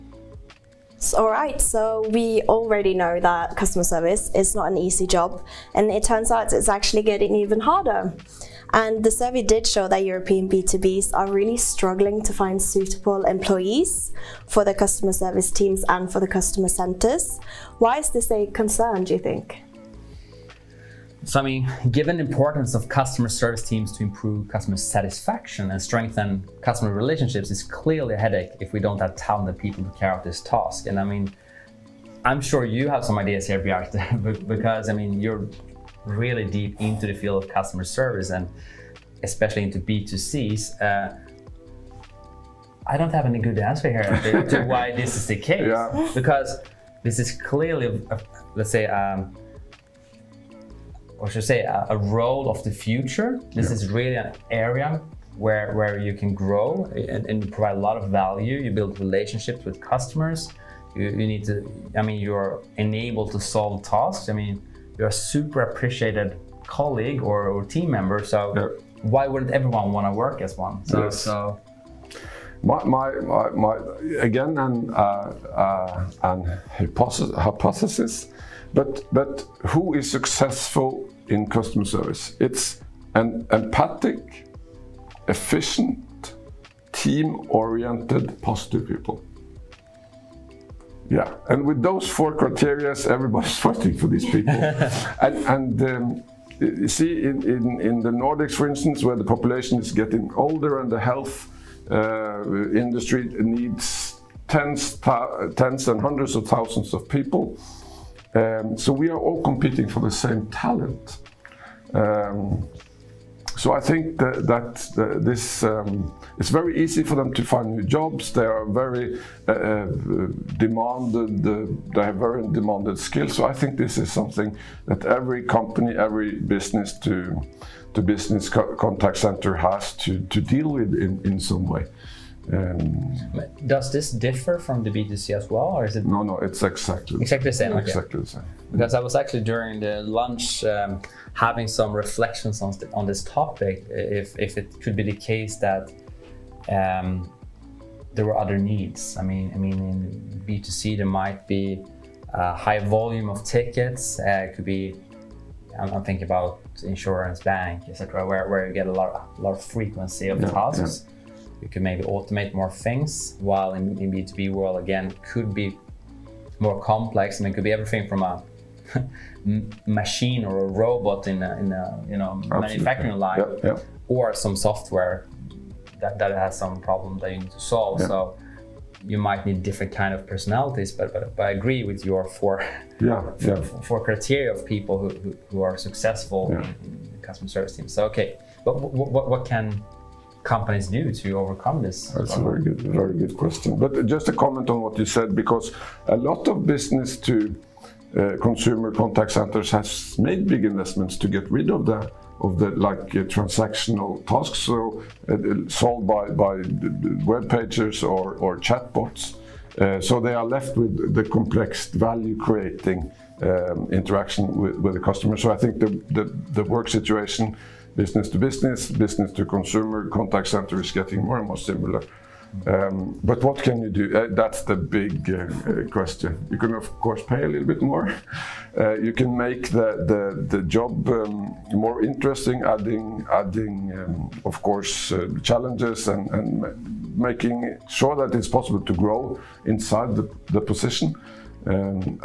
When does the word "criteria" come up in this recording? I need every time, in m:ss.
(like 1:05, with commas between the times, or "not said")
1:32, 3:04.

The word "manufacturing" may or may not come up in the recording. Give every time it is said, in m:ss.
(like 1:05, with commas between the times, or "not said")
2:52.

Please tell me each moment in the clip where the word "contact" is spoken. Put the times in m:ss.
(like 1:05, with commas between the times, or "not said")
2:08, 3:18, 3:40.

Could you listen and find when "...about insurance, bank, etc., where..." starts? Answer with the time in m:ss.
2:36.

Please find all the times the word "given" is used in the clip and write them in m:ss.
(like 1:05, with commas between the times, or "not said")
0:21.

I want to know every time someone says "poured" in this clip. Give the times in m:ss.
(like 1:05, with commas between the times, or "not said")
not said.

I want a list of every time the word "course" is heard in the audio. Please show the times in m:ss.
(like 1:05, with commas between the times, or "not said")
3:47, 3:54.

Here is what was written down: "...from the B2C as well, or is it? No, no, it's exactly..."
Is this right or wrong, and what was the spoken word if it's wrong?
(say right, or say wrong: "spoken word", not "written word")
right.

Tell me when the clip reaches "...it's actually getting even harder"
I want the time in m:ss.
0:06.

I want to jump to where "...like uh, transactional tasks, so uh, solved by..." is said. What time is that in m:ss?
3:22.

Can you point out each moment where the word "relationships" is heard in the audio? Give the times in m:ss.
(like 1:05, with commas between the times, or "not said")
0:26, 0:58.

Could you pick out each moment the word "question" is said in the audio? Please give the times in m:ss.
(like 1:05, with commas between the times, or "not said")
3:13, 3:45.